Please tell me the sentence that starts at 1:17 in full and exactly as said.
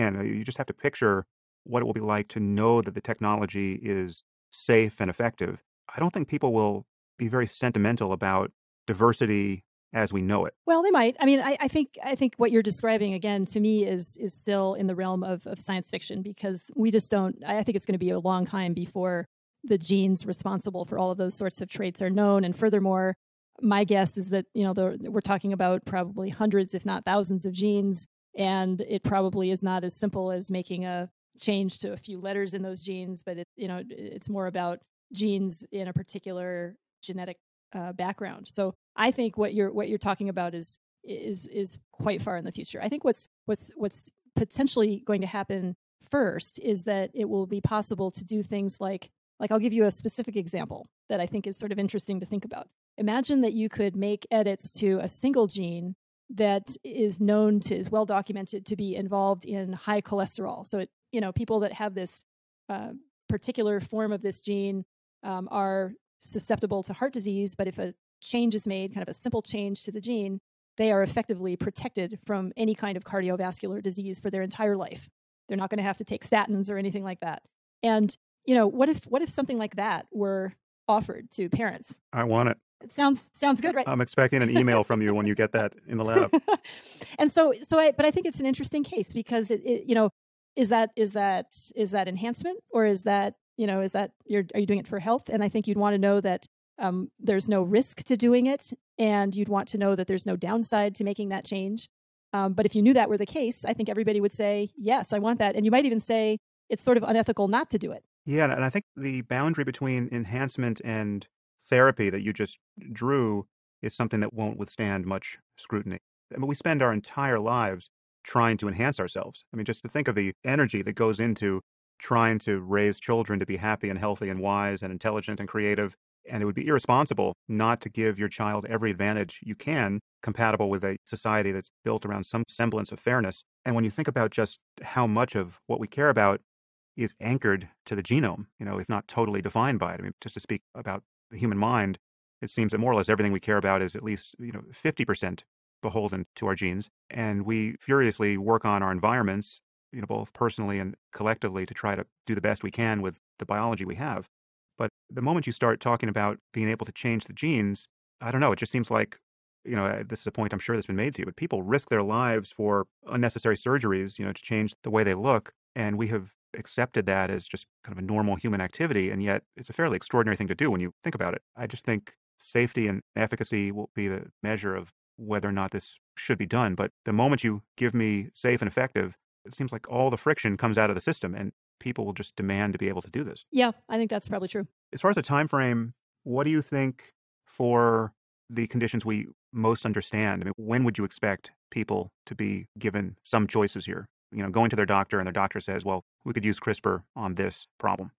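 And you know, what if what if something like that were offered to parents?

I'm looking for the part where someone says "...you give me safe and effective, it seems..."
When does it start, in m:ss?
2:57.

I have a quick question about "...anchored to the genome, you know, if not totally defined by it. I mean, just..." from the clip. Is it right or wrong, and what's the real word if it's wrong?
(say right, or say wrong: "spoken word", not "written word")
right.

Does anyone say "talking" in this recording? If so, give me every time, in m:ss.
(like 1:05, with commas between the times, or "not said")
0:25, 0:39, 2:35.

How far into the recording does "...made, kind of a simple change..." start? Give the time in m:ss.
1:08.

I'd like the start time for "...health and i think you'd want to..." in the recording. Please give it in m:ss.
1:34.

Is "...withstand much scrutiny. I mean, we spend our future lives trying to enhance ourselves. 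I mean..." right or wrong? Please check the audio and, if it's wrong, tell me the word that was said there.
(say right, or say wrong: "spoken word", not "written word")
wrong: "entire", not "future".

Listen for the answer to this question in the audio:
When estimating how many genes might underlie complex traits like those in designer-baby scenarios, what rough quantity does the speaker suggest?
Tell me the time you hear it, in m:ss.
0:26.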